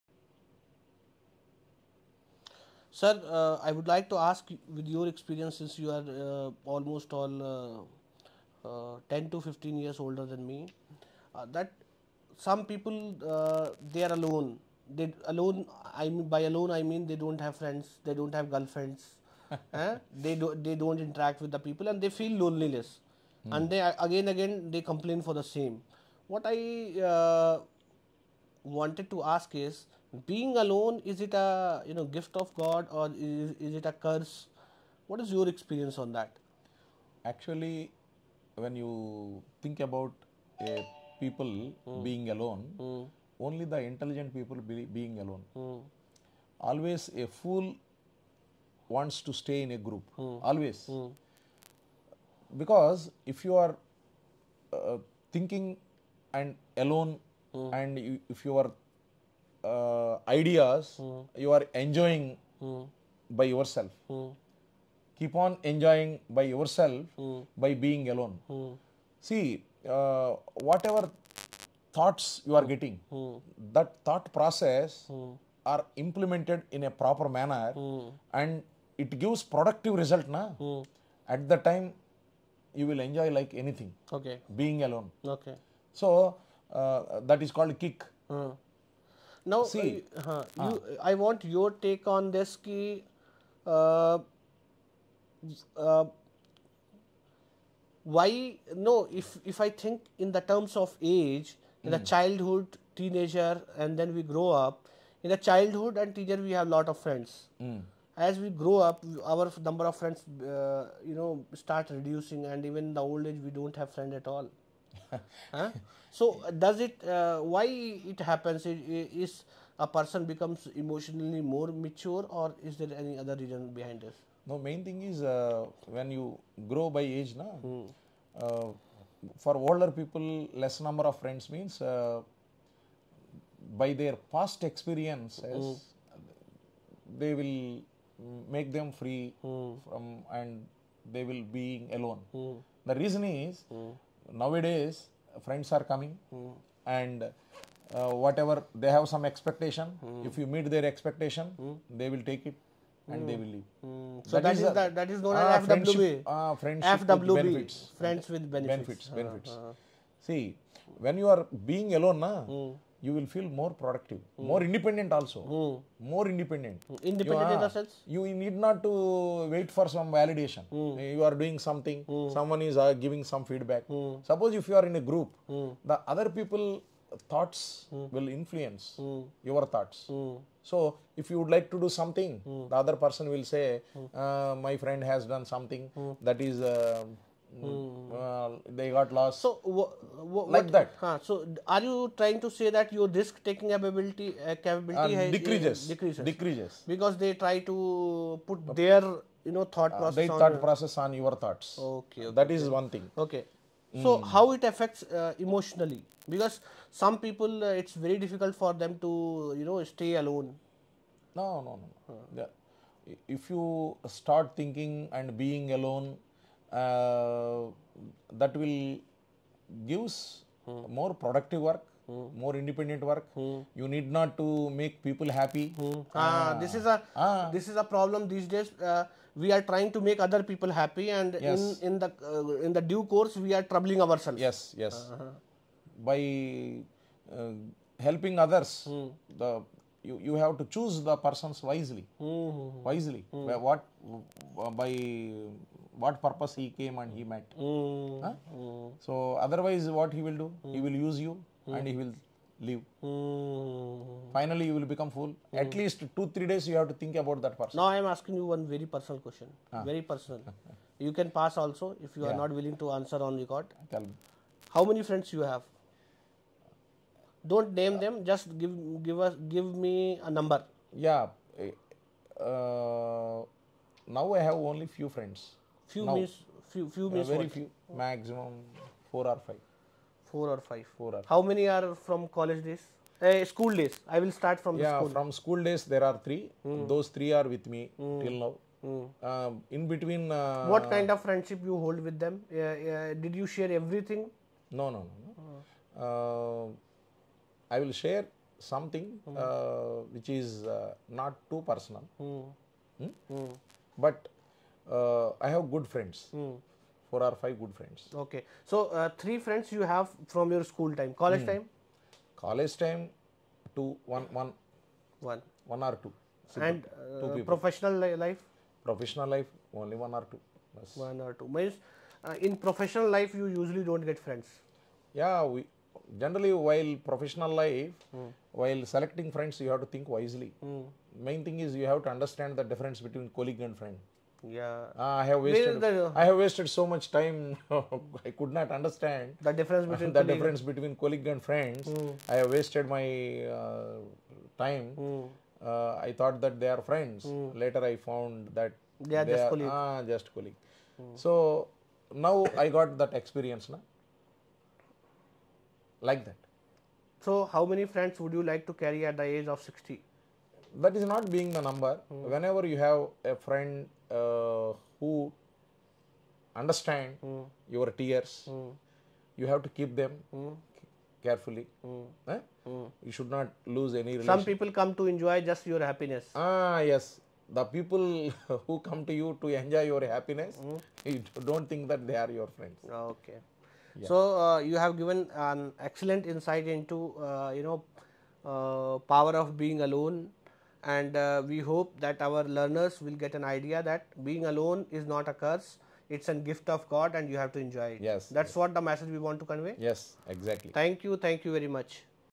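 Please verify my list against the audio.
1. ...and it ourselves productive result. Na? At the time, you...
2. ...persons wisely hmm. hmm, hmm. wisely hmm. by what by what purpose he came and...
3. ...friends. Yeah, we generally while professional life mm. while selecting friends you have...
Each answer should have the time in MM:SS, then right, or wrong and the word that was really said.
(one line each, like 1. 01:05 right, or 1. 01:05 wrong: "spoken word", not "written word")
1. 01:18 wrong: "gives", not "ourselves"
2. 04:01 right
3. 05:24 right.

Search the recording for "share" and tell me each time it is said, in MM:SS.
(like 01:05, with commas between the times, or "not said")
04:53, 04:57.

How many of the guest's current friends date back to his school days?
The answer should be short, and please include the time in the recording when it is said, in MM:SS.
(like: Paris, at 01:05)
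3, at 04:45.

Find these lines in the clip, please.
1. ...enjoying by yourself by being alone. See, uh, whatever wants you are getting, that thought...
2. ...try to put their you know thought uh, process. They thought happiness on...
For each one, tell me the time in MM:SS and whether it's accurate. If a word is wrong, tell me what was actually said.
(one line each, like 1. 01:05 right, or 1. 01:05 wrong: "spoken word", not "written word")
1. 01:05 wrong: "thoughts", not "wants"
2. 03:17 wrong: "process", not "happiness".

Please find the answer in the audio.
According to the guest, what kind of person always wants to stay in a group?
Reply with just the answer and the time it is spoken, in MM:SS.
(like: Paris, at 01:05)
a fool, at 00:47.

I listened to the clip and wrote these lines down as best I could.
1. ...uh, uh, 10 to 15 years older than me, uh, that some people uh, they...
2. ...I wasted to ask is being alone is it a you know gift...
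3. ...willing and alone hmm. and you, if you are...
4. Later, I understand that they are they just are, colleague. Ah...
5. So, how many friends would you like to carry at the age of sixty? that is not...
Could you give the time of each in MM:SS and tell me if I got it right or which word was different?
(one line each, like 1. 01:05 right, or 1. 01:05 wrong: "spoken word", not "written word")
1. 00:08 right
2. 00:26 wrong: "wanted", not "wasted"
3. 00:55 wrong: "thinking", not "willing"
4. 05:47 wrong: "found", not "understand"
5. 05:57 right.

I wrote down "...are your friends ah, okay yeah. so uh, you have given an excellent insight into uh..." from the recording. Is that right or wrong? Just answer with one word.
right.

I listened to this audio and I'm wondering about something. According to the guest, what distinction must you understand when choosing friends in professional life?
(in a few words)
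colleague and friend.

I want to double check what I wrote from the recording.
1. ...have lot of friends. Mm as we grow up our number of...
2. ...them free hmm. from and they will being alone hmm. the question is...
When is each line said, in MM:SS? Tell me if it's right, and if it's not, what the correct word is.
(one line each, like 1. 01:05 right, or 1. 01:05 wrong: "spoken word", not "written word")
1. 01:46 right
2. 02:18 wrong: "reason", not "question".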